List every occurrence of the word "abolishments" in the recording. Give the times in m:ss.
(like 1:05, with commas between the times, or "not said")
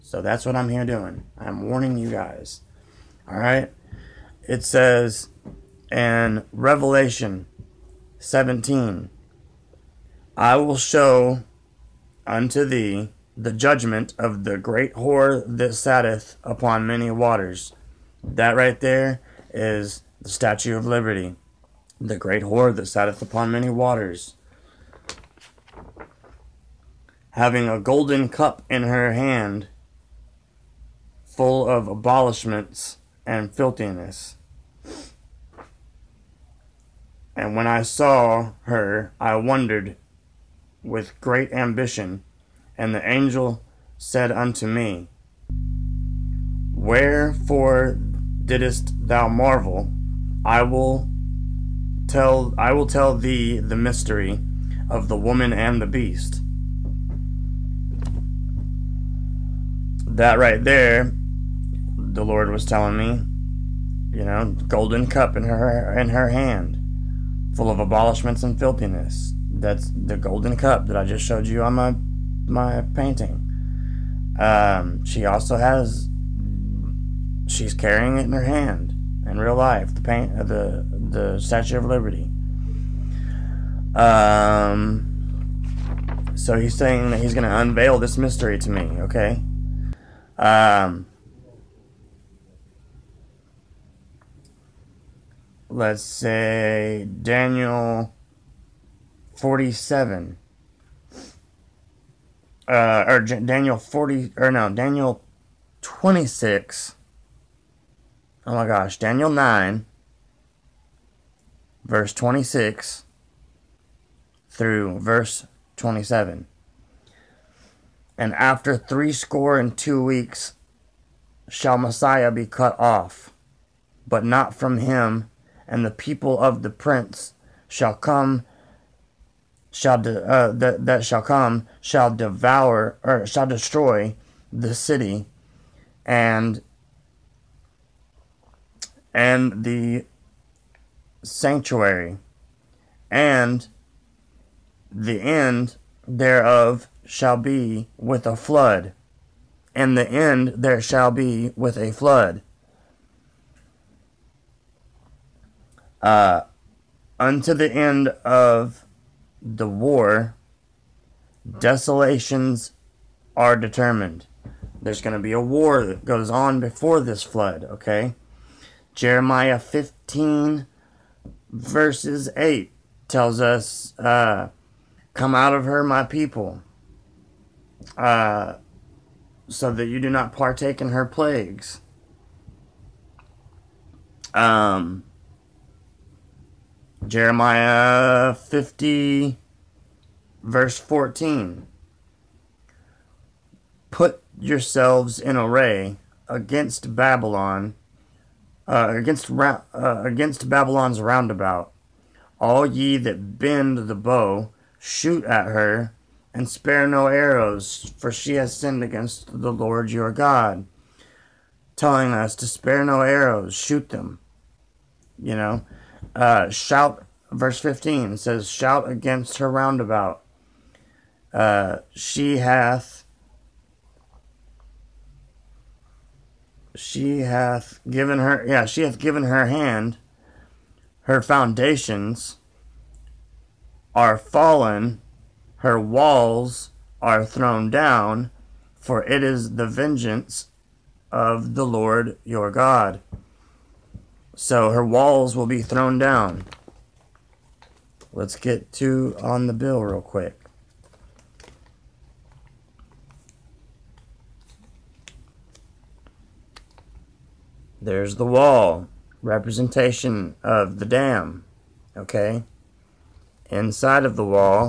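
0:31, 1:07.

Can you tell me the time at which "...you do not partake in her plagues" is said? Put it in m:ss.
2:59.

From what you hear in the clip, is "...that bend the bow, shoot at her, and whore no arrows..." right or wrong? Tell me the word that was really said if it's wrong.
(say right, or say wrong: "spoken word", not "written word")
wrong: "spare", not "whore".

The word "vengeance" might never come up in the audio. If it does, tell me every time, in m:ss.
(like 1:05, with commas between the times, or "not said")
3:59.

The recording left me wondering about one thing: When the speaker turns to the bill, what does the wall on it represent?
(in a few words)
The dam.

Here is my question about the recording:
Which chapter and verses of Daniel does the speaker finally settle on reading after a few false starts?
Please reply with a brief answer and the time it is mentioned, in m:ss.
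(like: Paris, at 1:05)
Daniel 9:26-27, at 1:48.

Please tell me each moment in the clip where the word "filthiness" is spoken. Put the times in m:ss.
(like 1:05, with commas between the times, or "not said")
0:33, 1:08.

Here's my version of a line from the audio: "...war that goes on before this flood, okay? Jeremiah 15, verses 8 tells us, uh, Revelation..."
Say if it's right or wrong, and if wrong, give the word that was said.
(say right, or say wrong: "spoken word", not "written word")
wrong: "Come", not "Revelation".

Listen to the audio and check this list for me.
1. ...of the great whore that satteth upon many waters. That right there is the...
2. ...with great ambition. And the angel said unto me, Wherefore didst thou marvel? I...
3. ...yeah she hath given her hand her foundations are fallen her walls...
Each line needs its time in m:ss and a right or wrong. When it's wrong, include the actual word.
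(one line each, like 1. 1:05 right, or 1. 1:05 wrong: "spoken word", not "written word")
1. 0:14 right
2. 0:40 right
3. 3:48 right.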